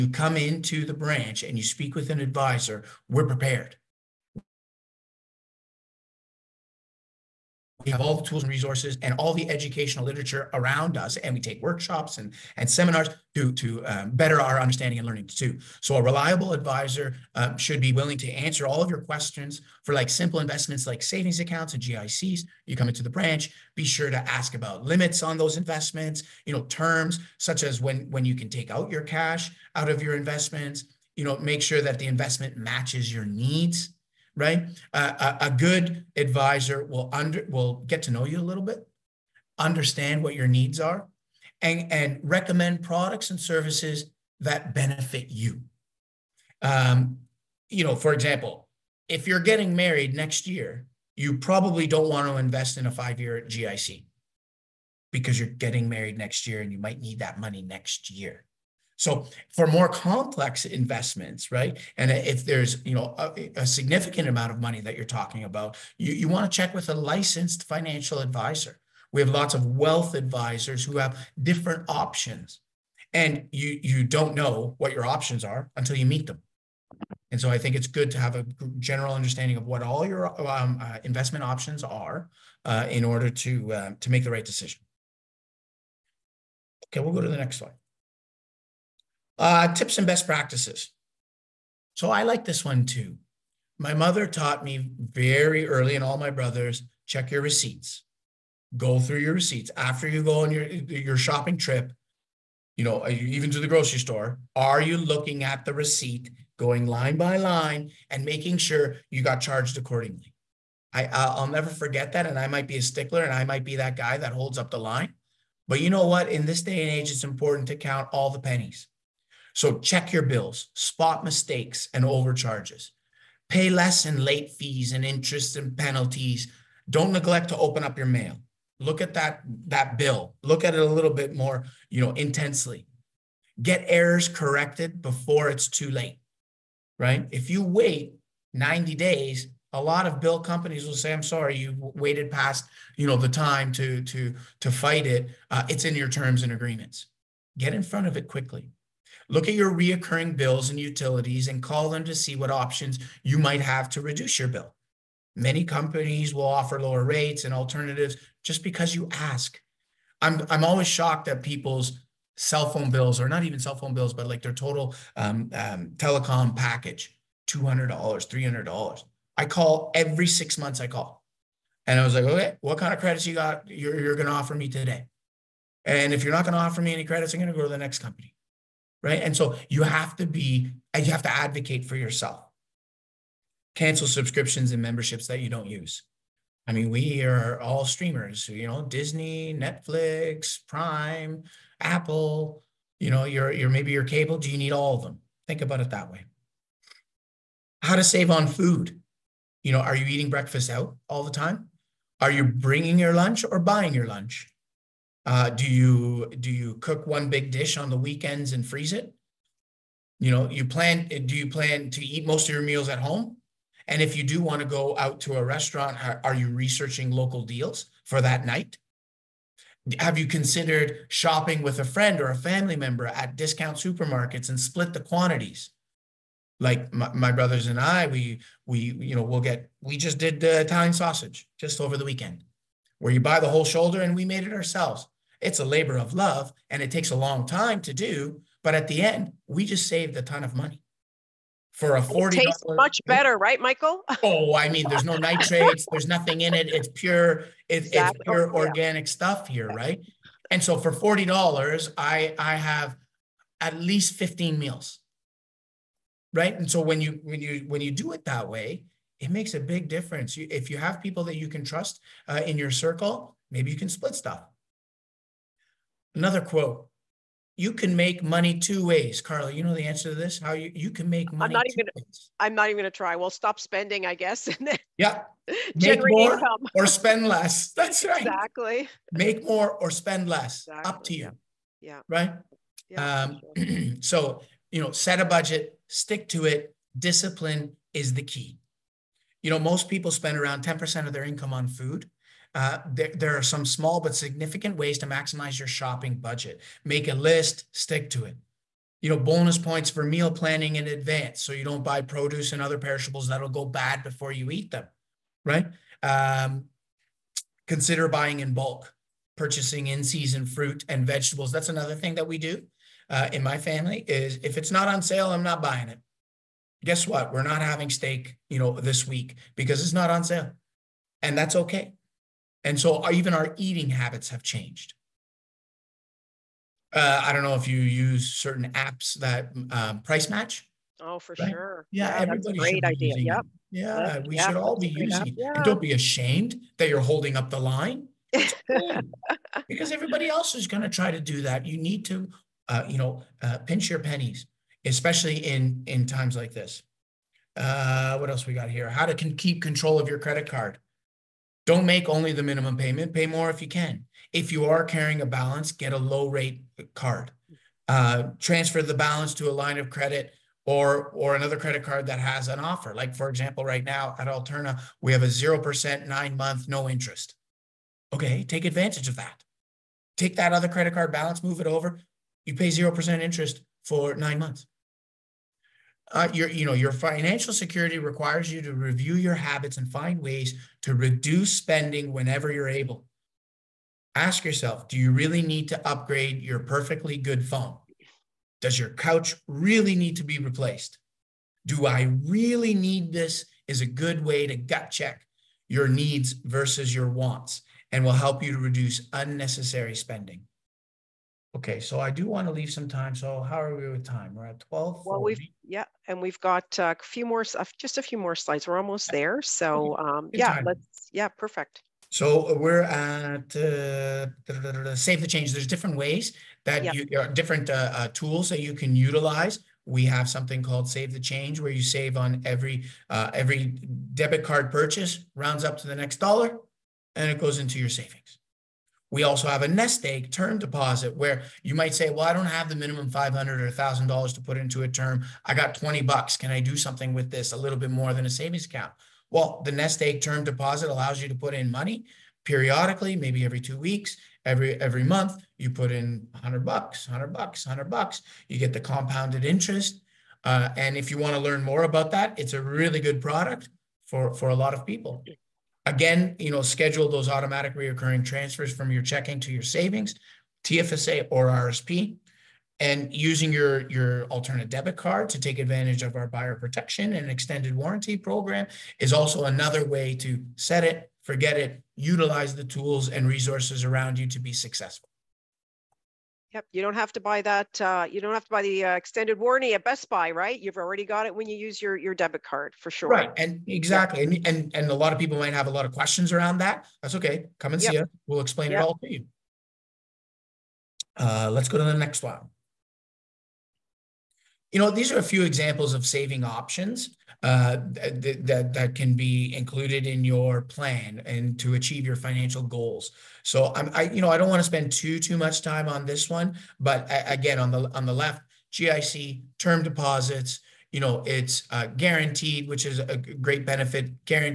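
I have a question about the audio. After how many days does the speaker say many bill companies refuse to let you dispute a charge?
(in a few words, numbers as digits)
90.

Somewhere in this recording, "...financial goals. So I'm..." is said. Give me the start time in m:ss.
8:22.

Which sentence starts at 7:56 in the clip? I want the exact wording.
Yep, you don't have to buy that.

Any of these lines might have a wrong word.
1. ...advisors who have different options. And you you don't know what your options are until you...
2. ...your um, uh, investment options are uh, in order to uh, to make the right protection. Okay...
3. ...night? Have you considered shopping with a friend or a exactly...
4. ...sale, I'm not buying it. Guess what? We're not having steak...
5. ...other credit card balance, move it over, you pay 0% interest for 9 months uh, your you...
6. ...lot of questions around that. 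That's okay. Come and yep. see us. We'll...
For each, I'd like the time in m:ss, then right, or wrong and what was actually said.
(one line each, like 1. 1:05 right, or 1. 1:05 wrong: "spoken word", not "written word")
1. 1:10 right
2. 1:20 wrong: "decision", not "protection"
3. 3:38 wrong: "family", not "exactly"
4. 5:15 right
5. 6:10 right
6. 8:05 right.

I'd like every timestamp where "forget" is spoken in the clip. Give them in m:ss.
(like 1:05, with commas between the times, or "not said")
1:51, 7:51.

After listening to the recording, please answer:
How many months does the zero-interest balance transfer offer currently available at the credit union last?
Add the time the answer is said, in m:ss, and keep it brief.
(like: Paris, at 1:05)
9, at 6:06.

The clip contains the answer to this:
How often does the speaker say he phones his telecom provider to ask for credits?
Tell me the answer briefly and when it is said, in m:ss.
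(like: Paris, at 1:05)
every 6 months, at 2:49.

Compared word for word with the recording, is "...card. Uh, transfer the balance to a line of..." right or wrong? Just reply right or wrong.
right.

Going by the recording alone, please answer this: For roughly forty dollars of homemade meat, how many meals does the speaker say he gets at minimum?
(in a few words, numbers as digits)
15.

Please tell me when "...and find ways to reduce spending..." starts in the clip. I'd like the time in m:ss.
6:19.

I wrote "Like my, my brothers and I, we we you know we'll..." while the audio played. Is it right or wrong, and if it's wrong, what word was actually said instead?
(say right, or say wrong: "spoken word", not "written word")
right.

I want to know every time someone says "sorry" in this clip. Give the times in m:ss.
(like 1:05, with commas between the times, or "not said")
2:21.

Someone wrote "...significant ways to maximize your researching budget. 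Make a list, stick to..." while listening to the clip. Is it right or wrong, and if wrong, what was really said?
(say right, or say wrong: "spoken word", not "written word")
wrong: "shopping", not "researching".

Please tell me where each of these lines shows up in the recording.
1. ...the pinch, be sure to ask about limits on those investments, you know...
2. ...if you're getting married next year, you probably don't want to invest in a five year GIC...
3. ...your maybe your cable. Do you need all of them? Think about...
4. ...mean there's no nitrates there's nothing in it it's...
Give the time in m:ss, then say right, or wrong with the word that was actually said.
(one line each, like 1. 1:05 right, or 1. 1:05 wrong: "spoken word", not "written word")
1. 0:23 wrong: "branch", not "pinch"
2. 0:49 right
3. 3:13 right
4. 4:04 right.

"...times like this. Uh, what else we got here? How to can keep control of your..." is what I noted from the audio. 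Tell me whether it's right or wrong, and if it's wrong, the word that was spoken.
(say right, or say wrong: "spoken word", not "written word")
right.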